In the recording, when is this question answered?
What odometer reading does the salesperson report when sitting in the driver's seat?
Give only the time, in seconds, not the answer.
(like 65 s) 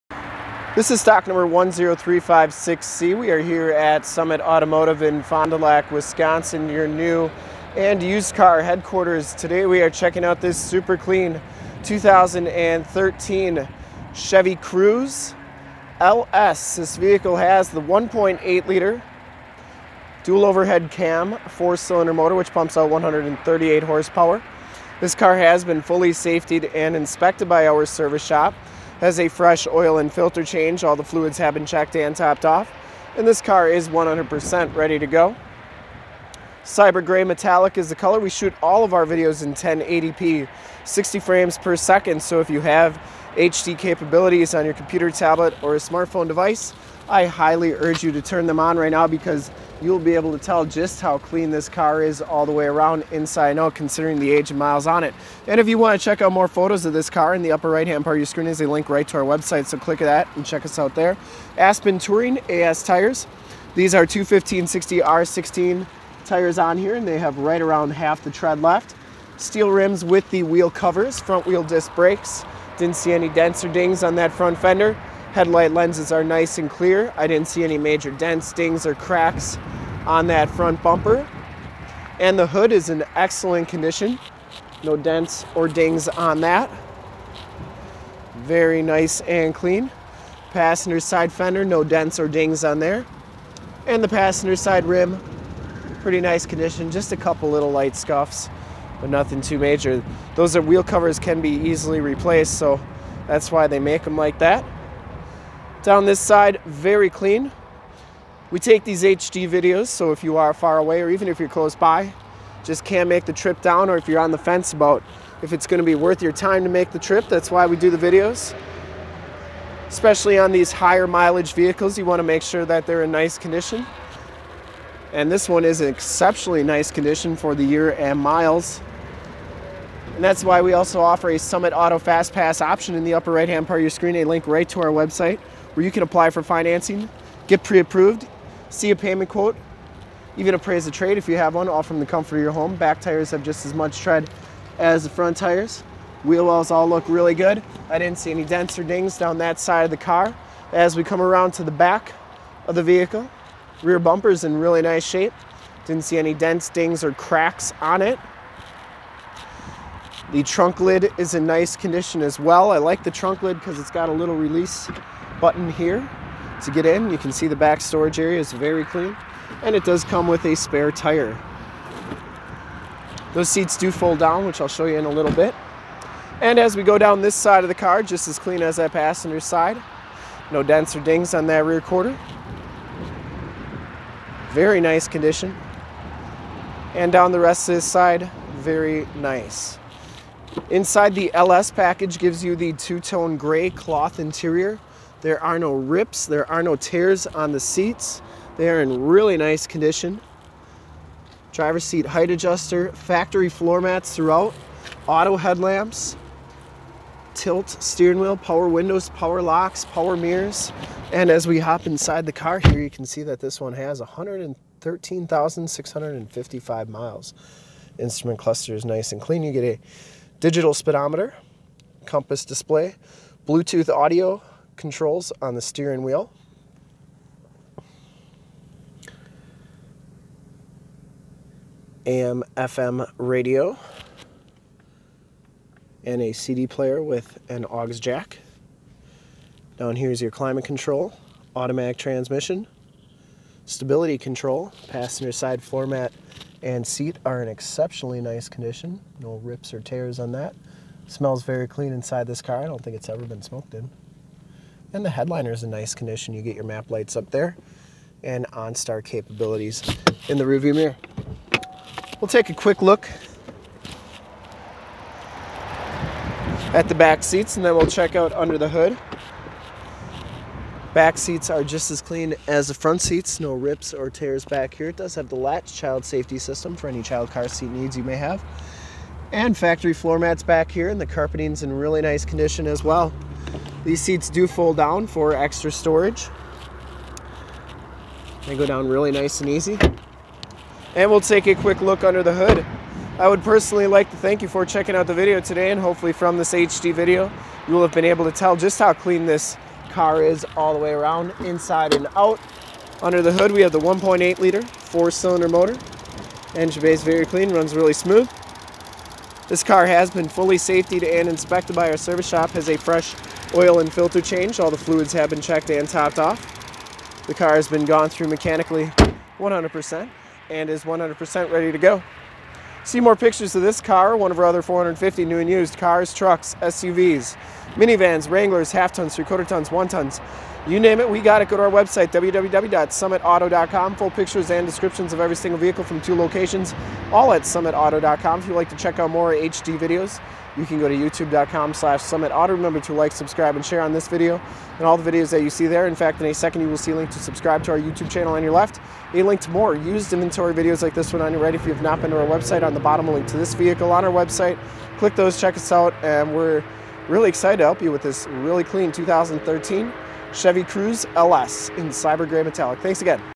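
214 s.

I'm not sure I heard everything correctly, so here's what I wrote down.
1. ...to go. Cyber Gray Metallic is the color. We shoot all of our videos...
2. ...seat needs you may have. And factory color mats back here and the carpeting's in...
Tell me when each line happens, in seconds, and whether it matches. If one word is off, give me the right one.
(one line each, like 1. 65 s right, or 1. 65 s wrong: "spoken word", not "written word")
1. 34 s right
2. 277 s wrong: "floor", not "color".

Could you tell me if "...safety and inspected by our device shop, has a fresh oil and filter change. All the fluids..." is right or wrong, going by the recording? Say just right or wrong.
wrong.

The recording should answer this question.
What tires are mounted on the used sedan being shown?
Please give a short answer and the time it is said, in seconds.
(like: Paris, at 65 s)
Aspen Touring AS, at 61 s.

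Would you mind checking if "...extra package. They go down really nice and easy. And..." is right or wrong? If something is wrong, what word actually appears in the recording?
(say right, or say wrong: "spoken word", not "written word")
wrong: "storage", not "package".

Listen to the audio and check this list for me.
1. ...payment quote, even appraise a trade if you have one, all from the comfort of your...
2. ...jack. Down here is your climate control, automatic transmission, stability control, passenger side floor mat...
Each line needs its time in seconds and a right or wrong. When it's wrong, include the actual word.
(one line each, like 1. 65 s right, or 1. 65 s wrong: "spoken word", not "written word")
1. 138 s right
2. 237 s right.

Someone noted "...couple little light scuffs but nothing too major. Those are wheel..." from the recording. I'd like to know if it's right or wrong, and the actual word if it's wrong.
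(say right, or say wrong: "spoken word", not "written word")
right.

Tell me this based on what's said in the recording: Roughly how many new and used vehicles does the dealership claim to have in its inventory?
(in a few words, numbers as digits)
450.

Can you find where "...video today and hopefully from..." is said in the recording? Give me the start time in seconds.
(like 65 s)
295 s.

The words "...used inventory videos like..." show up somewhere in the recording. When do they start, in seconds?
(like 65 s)
349 s.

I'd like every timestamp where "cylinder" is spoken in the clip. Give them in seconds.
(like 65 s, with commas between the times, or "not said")
21 s, 304 s.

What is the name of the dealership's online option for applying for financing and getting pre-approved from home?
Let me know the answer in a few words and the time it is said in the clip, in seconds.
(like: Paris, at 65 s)
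Summit Auto Fast Pass, at 131 s.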